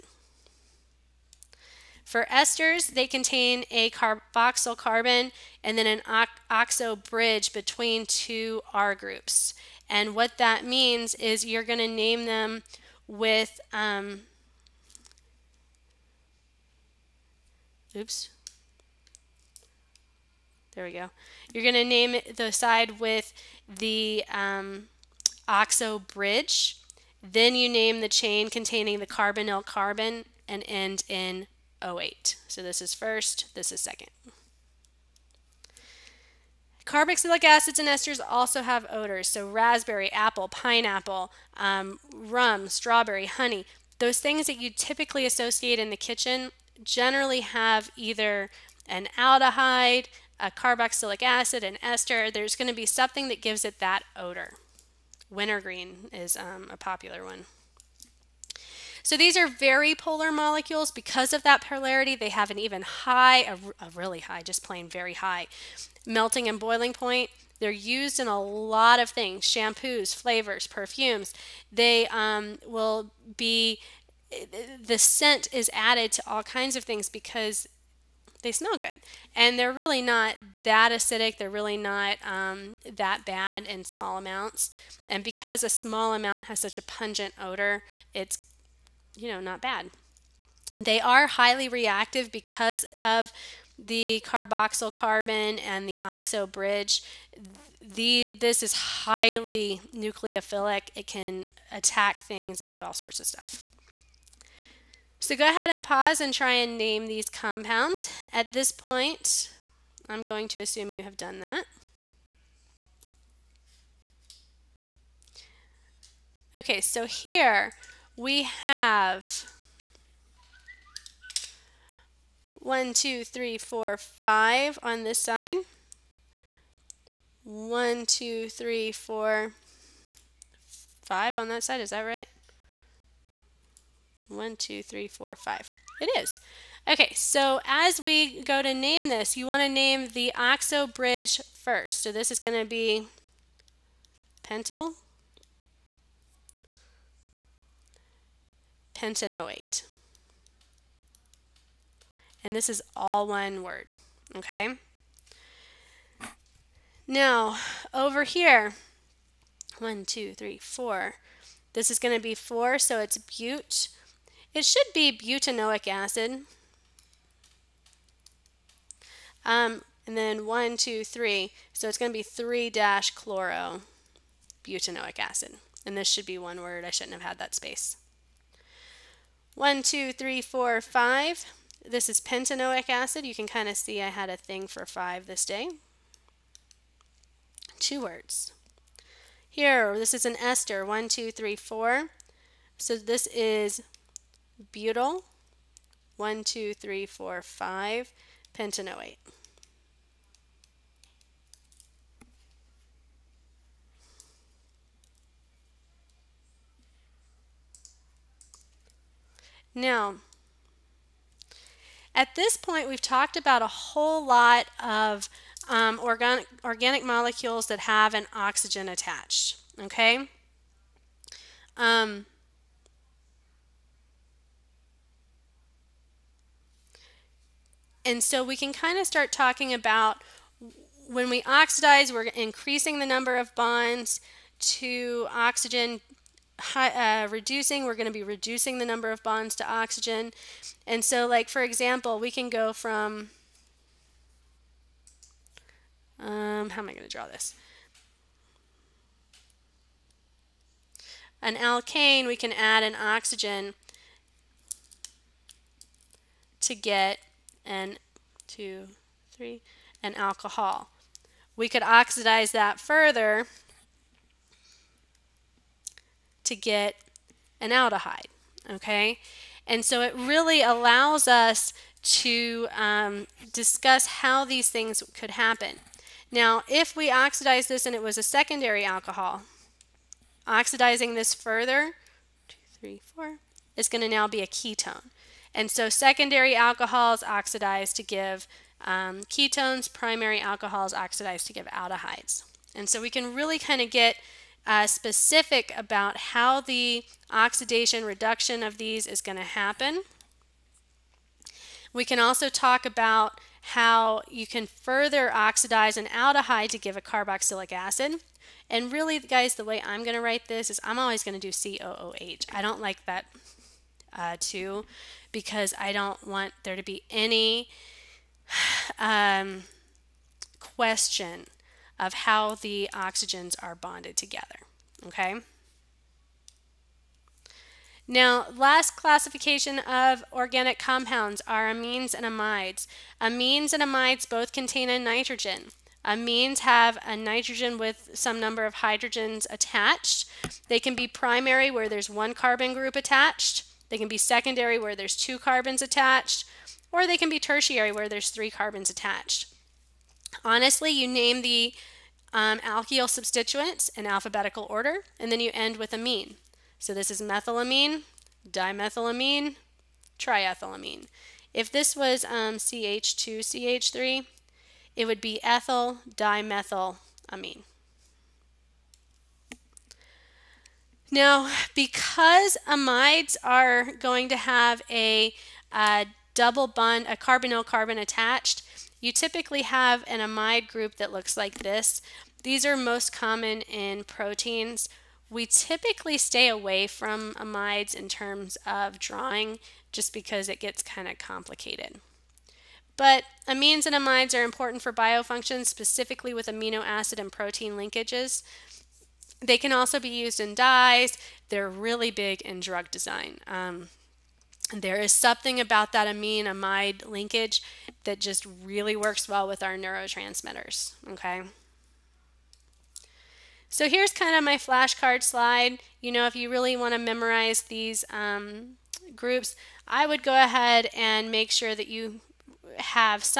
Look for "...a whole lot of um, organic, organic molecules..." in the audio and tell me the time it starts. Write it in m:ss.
3:33.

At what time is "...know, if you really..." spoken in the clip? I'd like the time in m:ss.
6:56.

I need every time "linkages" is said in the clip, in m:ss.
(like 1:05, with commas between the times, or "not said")
6:37, 6:47.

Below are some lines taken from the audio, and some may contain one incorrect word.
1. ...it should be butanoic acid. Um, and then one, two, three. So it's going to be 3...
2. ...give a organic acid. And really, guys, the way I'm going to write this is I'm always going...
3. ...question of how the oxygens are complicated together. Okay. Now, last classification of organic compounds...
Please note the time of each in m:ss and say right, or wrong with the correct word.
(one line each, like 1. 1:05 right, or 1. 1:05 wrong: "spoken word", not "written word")
1. 2:44 right
2. 5:06 wrong: "carboxylic", not "organic"
3. 5:20 wrong: "bonded", not "complicated".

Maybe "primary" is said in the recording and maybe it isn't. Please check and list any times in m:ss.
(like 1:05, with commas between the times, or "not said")
4:49, 5:41.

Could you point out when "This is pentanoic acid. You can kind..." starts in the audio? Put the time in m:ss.
3:01.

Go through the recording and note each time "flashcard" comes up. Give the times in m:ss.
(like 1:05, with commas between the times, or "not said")
6:54.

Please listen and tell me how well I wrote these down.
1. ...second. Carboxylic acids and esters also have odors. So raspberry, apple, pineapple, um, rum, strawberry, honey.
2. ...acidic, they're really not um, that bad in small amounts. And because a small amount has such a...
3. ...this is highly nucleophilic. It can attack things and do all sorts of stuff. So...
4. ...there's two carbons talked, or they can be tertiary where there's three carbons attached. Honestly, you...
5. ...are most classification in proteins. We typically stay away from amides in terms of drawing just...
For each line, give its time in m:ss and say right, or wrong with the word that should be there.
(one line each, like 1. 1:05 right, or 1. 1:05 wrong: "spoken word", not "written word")
1. 0:33 right
2. 1:20 right
3. 1:38 right
4. 5:44 wrong: "attached", not "talked"
5. 6:22 wrong: "common", not "classification".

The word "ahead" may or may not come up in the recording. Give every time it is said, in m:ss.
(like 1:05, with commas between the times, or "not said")
1:45, 7:00.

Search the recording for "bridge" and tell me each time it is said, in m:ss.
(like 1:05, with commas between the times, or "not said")
0:06, 0:25, 1:36, 2:20.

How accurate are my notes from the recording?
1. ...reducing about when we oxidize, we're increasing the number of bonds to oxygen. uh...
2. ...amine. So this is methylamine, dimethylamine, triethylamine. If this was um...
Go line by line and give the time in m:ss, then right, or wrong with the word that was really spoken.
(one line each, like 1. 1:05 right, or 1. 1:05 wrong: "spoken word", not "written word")
1. 3:49 wrong: "talking", not "reducing"
2. 5:55 right.